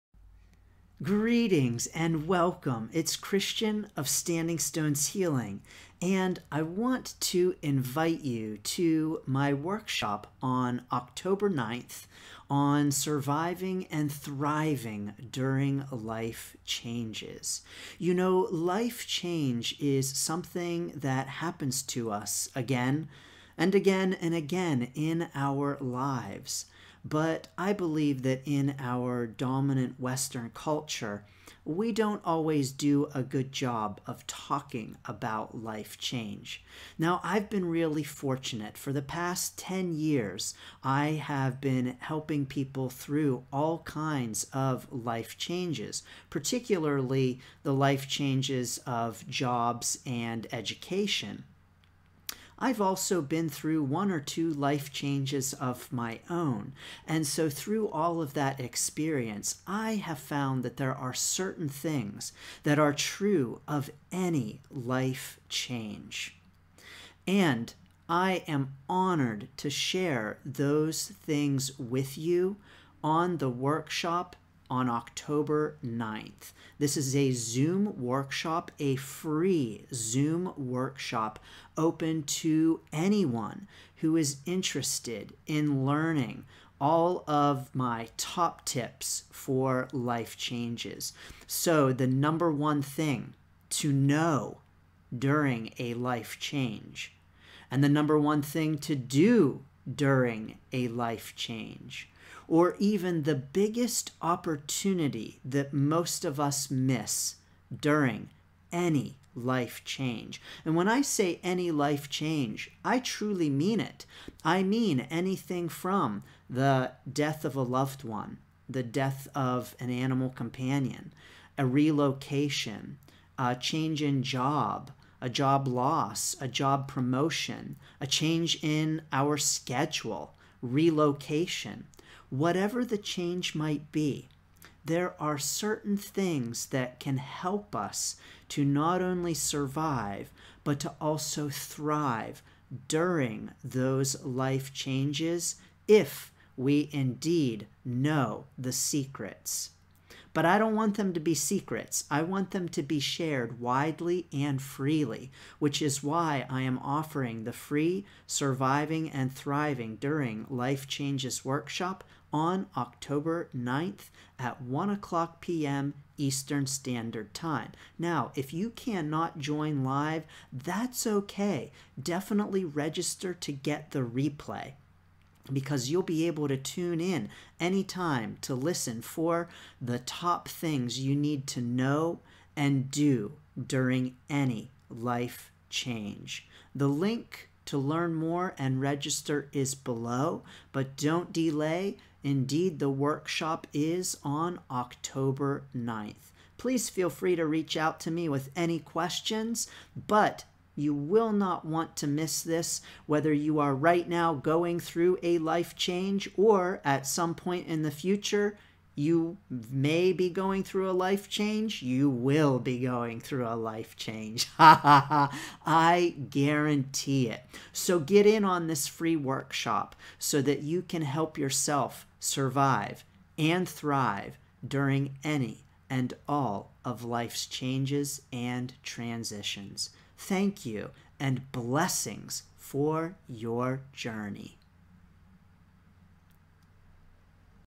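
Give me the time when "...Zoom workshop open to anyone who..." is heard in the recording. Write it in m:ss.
1:19.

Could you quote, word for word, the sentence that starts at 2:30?
But I don't want them to be secrets.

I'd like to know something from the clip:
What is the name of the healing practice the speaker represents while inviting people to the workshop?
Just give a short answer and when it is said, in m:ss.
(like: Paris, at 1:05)
Standing Stones Healing, at 0:04.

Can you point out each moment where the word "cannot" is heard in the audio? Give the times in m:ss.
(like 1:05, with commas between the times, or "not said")
2:48.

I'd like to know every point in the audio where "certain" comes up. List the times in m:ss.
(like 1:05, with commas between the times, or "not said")
1:01, 2:15.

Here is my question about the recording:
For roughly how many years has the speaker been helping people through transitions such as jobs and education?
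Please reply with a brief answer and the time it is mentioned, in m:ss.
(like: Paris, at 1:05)
10 years, at 0:39.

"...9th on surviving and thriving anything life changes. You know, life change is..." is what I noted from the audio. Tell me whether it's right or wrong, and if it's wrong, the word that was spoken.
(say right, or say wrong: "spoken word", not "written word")
wrong: "during", not "anything".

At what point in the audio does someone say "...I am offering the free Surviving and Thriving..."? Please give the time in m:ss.
2:36.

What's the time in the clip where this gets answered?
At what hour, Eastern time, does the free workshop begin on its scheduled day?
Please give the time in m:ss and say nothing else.
2:44.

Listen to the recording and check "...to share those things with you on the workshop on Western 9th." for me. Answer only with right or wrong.
wrong.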